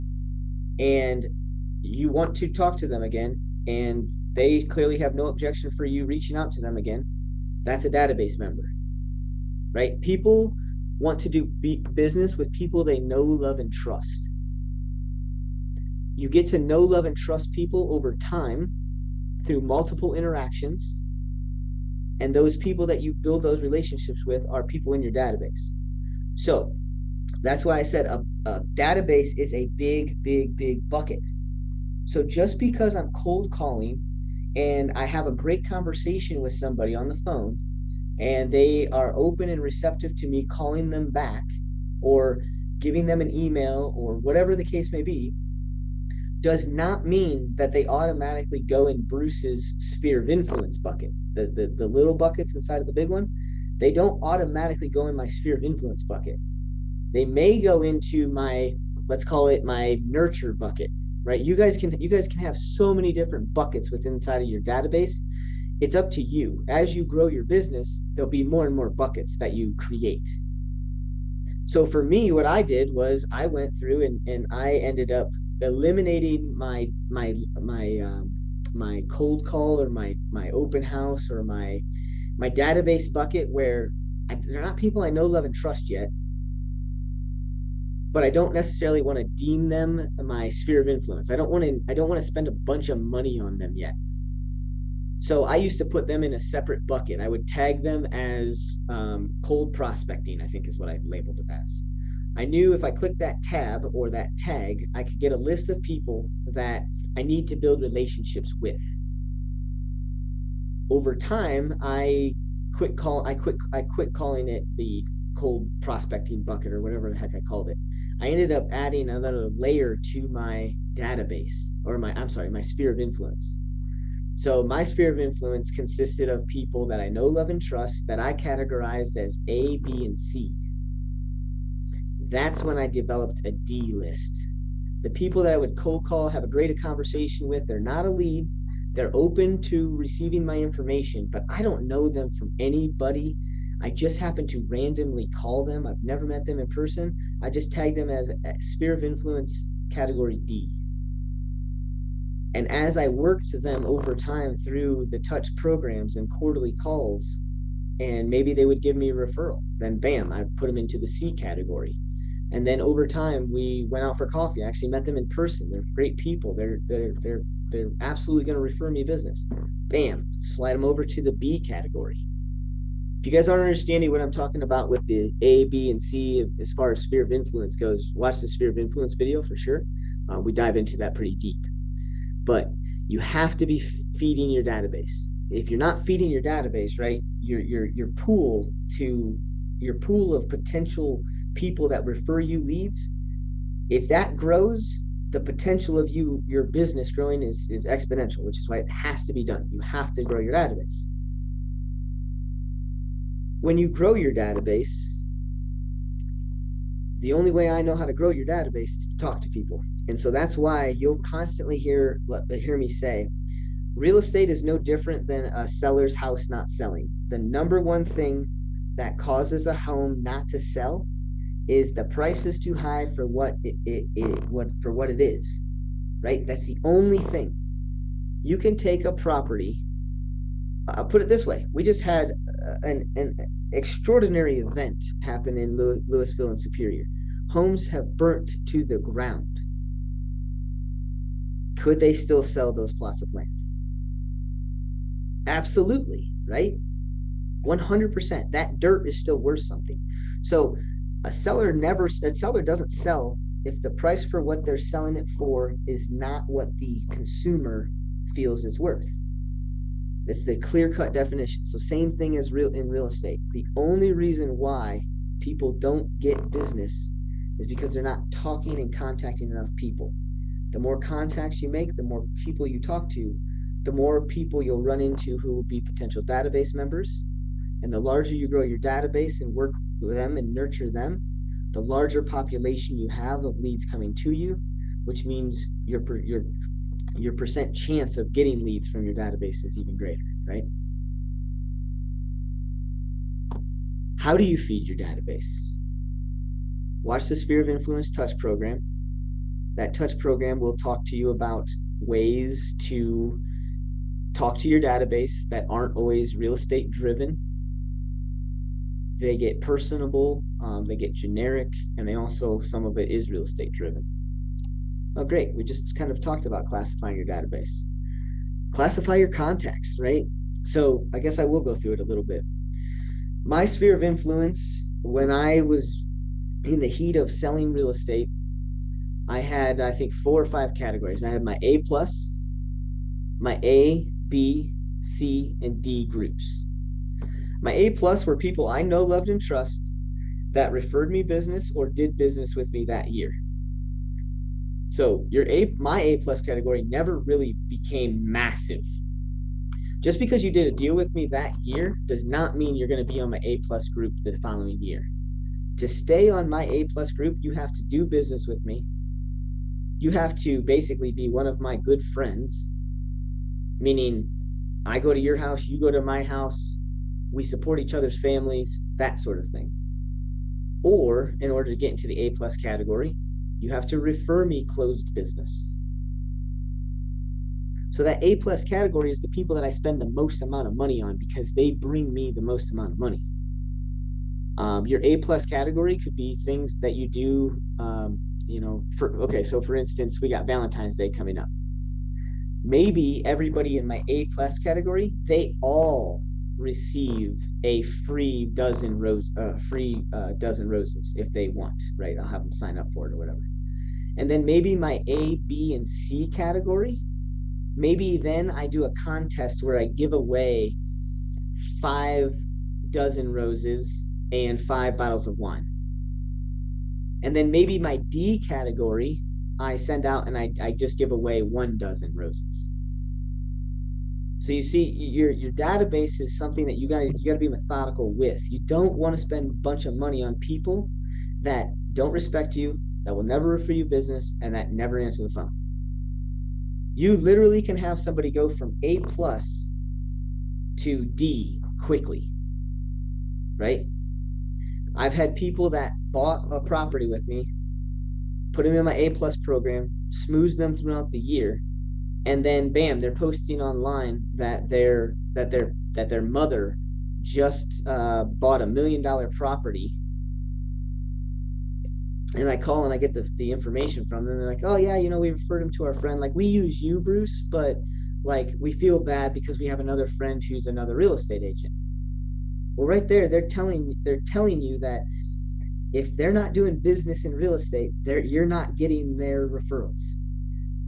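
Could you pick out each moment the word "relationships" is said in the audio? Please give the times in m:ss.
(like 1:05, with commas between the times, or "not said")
0:23, 1:47.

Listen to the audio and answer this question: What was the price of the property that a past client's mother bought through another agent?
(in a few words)
million dollar.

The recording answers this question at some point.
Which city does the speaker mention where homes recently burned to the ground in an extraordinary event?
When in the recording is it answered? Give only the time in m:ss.
3:56.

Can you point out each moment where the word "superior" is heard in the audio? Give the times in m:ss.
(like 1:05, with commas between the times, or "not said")
3:56.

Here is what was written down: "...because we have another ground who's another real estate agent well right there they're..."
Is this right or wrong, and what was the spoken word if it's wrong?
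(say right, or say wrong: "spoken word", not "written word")
wrong: "friend", not "ground".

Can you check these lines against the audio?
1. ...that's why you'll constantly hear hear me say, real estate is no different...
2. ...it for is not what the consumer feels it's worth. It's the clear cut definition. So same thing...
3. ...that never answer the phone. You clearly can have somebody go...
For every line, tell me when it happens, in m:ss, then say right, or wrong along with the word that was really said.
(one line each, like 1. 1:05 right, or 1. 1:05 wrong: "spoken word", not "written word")
1. 3:30 right
2. 4:15 right
3. 7:14 wrong: "literally", not "clearly".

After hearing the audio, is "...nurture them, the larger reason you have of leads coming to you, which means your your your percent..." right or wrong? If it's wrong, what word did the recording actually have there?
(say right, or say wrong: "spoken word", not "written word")
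wrong: "population", not "reason".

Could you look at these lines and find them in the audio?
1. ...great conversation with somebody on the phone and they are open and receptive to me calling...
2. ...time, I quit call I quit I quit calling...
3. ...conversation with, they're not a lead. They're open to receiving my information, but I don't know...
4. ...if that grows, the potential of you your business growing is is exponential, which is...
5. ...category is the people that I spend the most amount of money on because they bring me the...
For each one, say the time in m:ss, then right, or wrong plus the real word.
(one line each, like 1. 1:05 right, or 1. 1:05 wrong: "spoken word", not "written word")
1. 0:35 right
2. 1:51 right
3. 2:16 right
4. 3:13 right
5. 6:18 right.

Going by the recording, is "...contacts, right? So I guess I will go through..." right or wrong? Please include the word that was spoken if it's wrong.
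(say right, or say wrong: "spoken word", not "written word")
right.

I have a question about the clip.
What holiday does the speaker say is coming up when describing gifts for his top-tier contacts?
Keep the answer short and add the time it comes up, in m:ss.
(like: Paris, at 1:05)
Valentine's Day, at 6:30.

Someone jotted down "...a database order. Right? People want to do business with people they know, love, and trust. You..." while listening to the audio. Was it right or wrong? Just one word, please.
wrong.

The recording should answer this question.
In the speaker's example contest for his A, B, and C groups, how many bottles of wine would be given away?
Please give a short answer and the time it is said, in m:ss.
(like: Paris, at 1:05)
5, at 6:54.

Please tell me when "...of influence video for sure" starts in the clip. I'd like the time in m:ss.
2:58.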